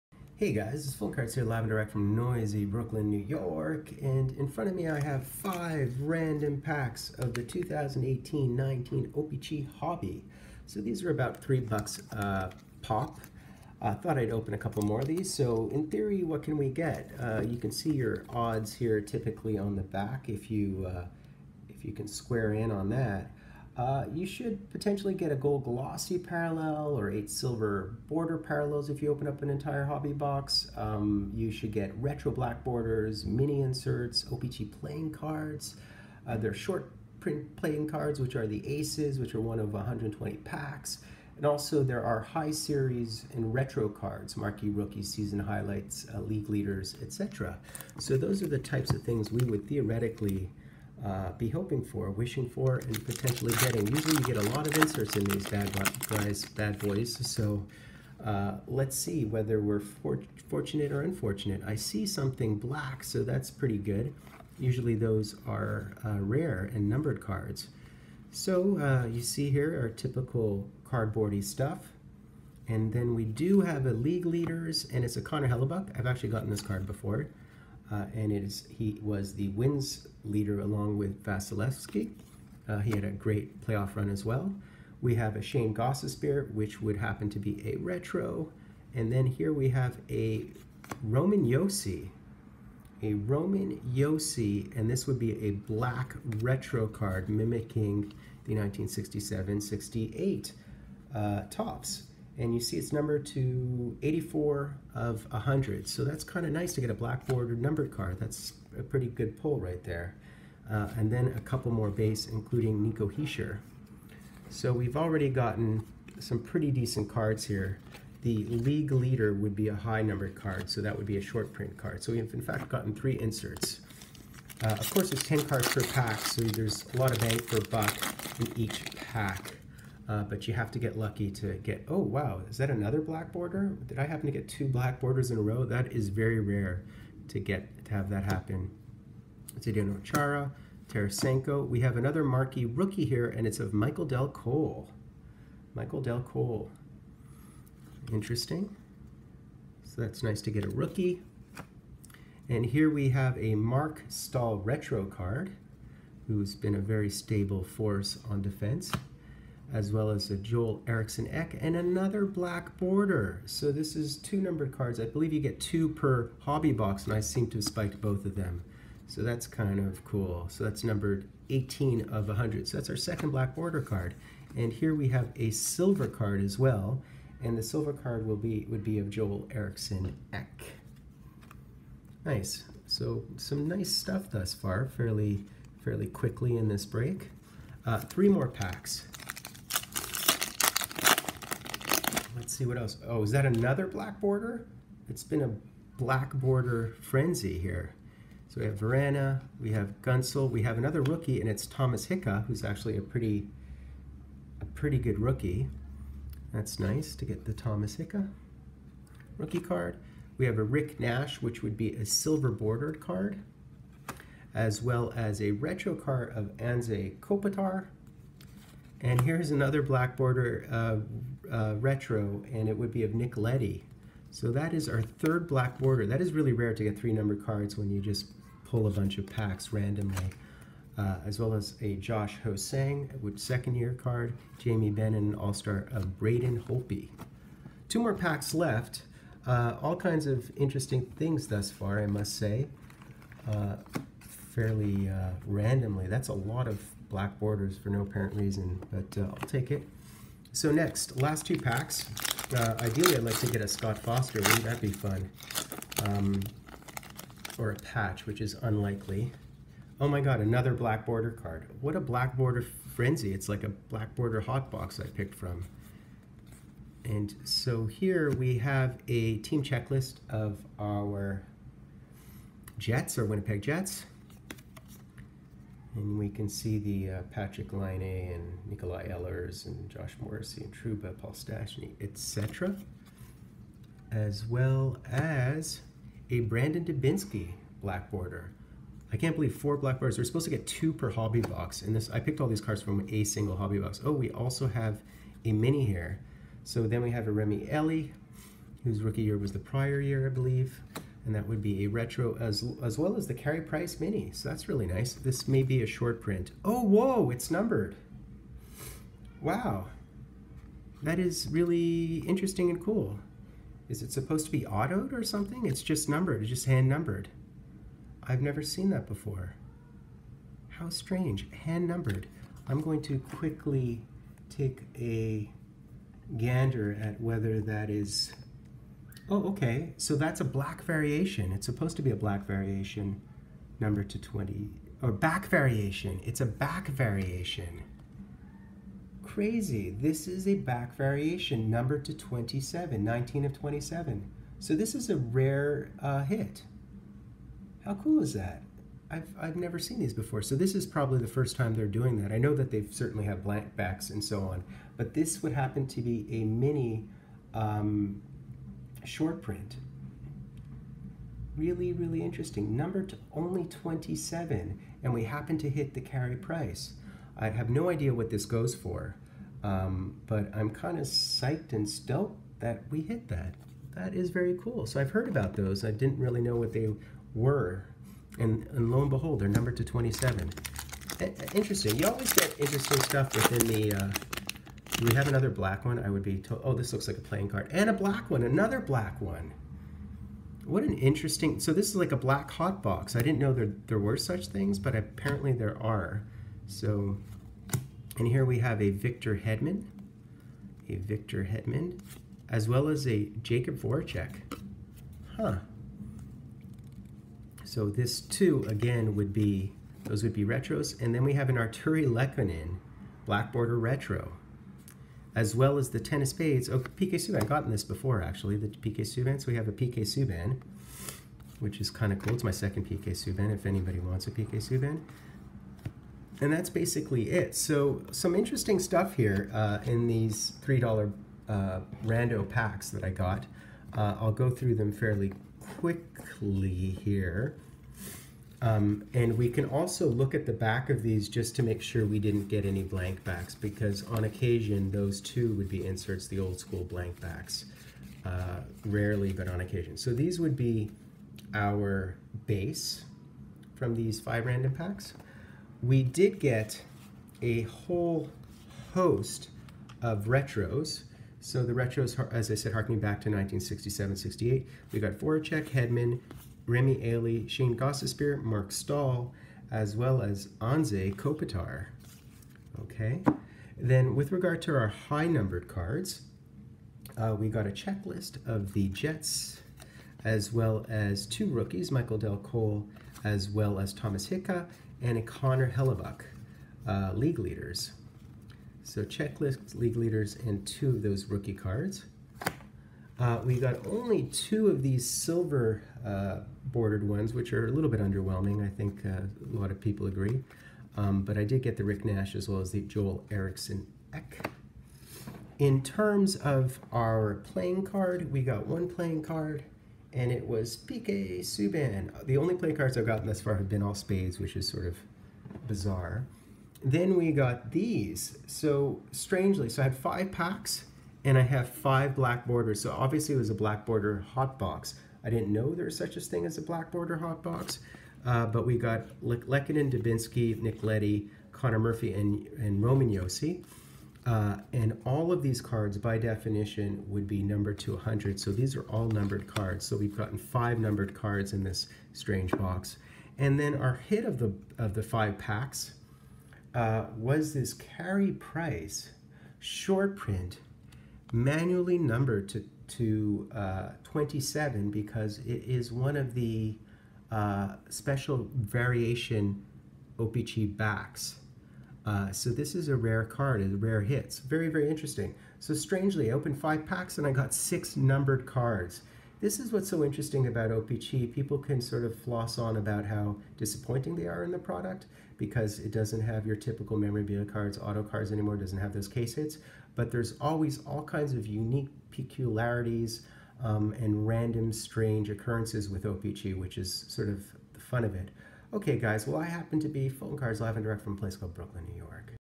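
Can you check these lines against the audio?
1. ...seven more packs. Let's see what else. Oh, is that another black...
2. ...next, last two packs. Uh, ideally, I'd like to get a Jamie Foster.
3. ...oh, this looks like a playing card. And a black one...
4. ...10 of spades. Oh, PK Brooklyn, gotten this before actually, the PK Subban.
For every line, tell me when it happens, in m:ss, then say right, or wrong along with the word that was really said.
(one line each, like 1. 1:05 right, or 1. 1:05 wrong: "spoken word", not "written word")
1. 3:07 wrong: "three", not "seven"
2. 4:10 wrong: "Scott", not "Jamie"
3. 6:26 right
4. 6:55 wrong: "Subban", not "Brooklyn".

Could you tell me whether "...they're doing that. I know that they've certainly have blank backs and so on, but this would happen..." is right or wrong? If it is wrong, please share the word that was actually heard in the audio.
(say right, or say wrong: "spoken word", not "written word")
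right.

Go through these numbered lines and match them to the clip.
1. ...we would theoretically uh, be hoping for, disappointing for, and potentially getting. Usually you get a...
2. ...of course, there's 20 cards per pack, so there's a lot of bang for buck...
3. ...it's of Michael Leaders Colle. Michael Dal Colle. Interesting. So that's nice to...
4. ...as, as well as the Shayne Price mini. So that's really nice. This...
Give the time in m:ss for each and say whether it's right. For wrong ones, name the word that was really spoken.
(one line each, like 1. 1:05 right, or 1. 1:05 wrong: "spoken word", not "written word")
1. 0:49 wrong: "wishing", not "disappointing"
2. 2:04 wrong: "10", not "20"
3. 2:23 wrong: "Dal", not "Leaders"
4. 5:02 wrong: "Carey", not "Shayne".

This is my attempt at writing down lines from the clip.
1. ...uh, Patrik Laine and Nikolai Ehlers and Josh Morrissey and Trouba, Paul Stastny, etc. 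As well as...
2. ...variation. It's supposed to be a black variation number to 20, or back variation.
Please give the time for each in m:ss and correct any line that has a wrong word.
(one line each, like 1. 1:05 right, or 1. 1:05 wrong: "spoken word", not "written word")
1. 4:37 right
2. 5:30 right.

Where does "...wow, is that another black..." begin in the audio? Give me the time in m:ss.
2:11.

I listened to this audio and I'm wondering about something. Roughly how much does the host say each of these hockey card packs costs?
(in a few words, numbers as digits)
$3.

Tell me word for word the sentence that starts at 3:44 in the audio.
So that is our third black border.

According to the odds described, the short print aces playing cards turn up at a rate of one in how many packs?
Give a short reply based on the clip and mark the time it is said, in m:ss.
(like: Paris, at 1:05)
120, at 0:39.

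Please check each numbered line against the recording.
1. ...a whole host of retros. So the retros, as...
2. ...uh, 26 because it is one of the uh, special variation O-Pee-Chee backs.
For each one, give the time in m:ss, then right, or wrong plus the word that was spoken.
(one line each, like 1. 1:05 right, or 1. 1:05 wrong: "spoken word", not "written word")
1. 7:37 right
2. 9:13 wrong: "27", not "26".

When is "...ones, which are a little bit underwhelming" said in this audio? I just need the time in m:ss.
8:17.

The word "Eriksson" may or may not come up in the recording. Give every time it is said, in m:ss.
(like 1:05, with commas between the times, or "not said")
2:40, 2:59, 8:23.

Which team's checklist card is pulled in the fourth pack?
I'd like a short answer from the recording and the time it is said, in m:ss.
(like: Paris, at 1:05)
Winnipeg Jets, at 4:33.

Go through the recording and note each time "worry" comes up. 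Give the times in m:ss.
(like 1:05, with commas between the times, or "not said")
not said.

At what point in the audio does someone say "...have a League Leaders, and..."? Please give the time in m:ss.
1:13.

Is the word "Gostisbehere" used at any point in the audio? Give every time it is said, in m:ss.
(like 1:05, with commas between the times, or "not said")
1:25, 7:47.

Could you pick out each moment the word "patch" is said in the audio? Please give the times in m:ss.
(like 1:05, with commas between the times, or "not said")
4:17.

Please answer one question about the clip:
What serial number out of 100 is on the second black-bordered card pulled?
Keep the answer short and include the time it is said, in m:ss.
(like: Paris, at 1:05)
18, at 2:51.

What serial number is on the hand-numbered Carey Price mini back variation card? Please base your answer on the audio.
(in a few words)
19 of 27.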